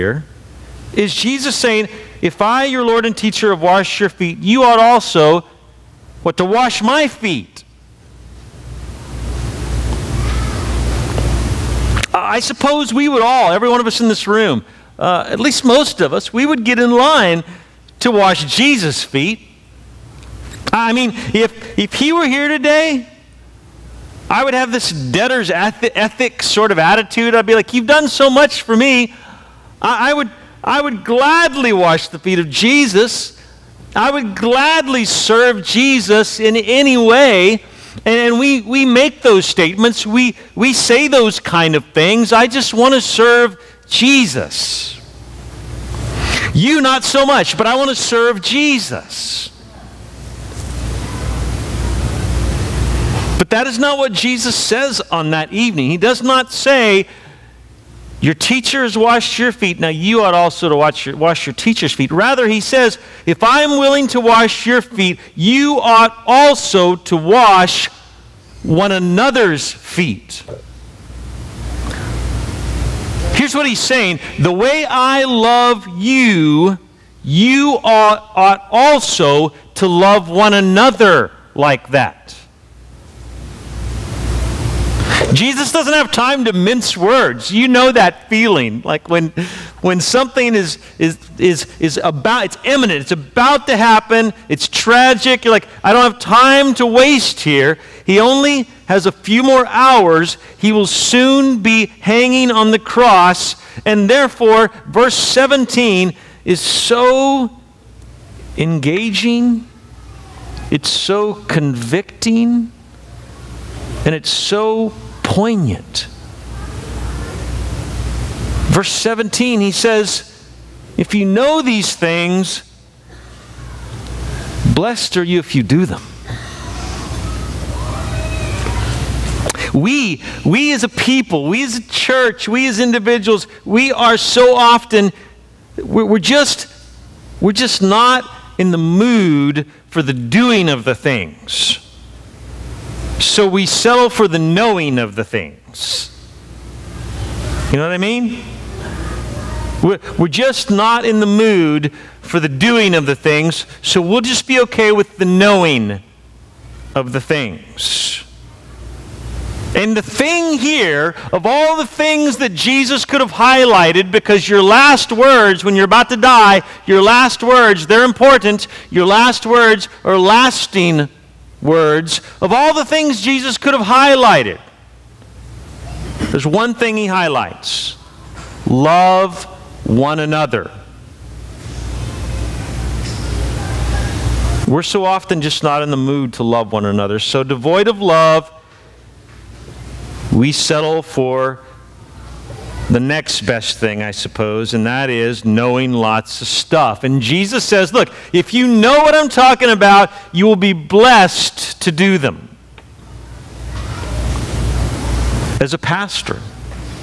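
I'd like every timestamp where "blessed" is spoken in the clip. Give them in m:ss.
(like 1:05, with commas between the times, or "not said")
2:04, 3:20.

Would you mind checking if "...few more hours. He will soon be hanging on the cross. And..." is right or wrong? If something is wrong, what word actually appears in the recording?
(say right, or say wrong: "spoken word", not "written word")
right.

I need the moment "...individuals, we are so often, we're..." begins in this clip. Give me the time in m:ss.
2:12.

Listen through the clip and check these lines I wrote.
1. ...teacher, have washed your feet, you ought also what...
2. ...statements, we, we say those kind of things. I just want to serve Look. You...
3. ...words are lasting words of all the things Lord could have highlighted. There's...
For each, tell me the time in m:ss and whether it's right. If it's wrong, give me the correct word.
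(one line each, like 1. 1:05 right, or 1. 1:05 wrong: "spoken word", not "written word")
1. 0:03 right
2. 0:39 wrong: "Jesus", not "Look"
3. 2:49 wrong: "Jesus", not "Lord".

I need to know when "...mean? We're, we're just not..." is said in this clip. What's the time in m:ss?
2:27.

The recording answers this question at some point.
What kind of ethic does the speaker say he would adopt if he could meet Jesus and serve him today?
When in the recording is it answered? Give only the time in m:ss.
0:24.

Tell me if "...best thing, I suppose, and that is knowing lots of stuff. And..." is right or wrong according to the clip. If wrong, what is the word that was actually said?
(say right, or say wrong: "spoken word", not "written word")
right.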